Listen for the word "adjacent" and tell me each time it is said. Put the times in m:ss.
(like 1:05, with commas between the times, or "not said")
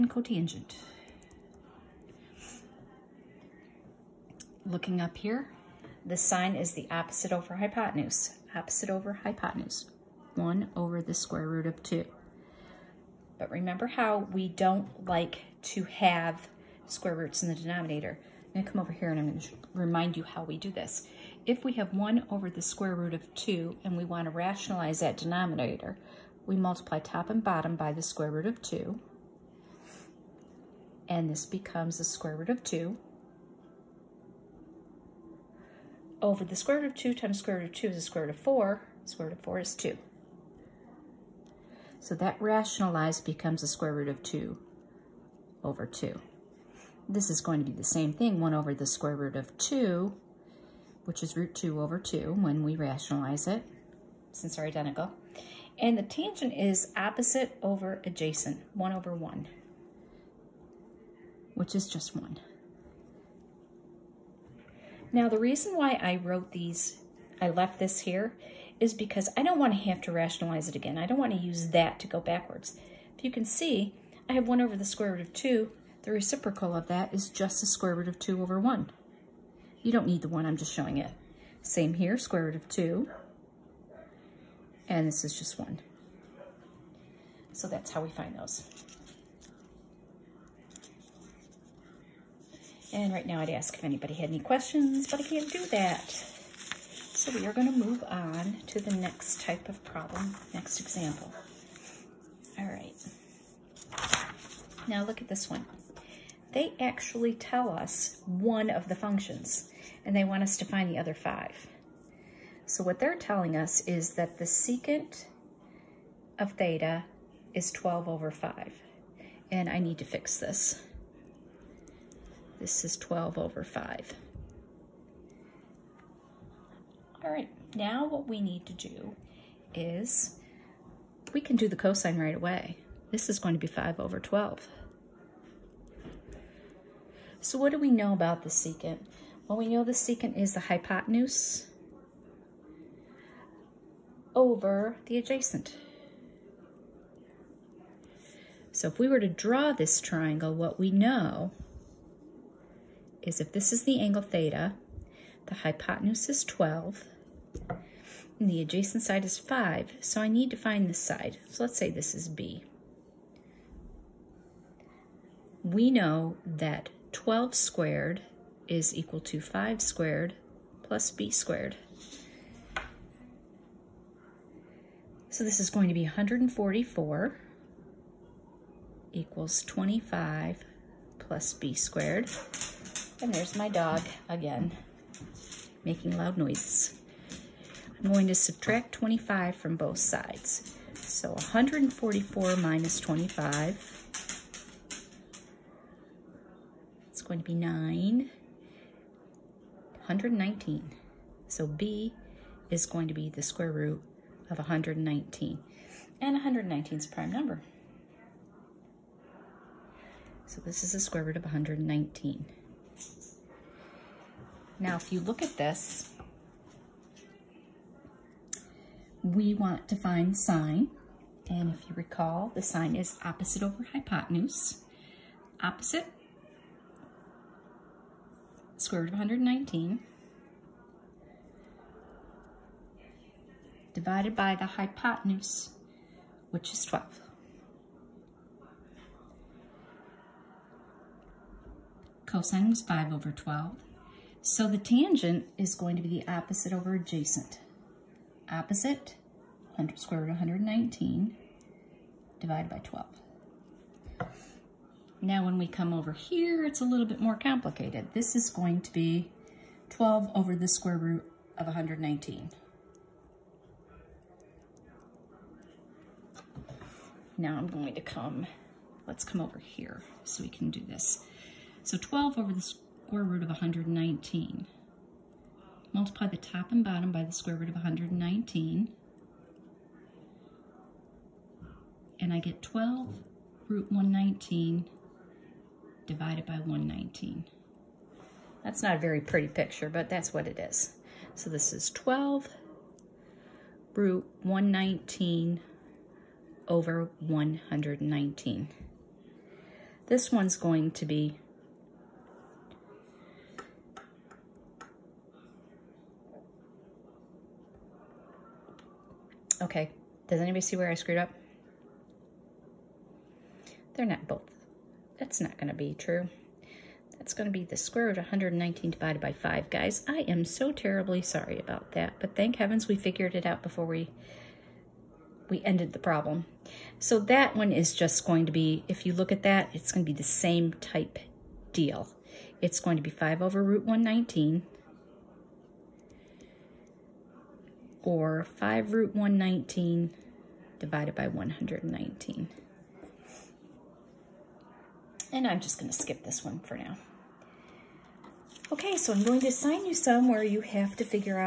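0:58, 2:25, 2:38, 4:06.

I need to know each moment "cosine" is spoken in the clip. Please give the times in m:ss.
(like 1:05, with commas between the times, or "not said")
2:11, 4:02.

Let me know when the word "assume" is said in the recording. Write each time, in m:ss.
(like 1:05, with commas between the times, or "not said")
not said.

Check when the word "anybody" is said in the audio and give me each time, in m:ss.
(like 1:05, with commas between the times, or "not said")
1:33, 5:10.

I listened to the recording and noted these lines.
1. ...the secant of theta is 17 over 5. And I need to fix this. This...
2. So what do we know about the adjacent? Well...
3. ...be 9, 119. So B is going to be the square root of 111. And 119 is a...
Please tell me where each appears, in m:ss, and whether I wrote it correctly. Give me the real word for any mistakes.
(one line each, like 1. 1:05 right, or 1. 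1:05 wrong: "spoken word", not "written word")
1. 1:54 wrong: "12", not "17"
2. 2:17 wrong: "secant", not "adjacent"
3. 3:17 wrong: "119", not "111".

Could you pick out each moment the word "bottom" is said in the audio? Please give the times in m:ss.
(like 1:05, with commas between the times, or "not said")
0:27, 4:36.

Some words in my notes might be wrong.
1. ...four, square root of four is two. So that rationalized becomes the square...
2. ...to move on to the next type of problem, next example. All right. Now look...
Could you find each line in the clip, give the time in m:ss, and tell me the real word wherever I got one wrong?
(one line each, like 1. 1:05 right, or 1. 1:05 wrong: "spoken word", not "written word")
1. 0:38 right
2. 1:37 right.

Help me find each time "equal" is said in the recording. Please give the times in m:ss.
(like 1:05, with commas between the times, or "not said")
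2:48, 2:59.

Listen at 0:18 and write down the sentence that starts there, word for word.
I'm gonna come over here and I'm gonna remind you how we do this.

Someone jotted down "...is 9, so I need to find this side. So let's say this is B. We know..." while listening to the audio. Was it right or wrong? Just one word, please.
wrong.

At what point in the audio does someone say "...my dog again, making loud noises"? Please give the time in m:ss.
3:03.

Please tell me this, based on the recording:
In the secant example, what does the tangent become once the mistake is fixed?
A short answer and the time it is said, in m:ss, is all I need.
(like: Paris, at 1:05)
square root of 119 over 5, at 5:17.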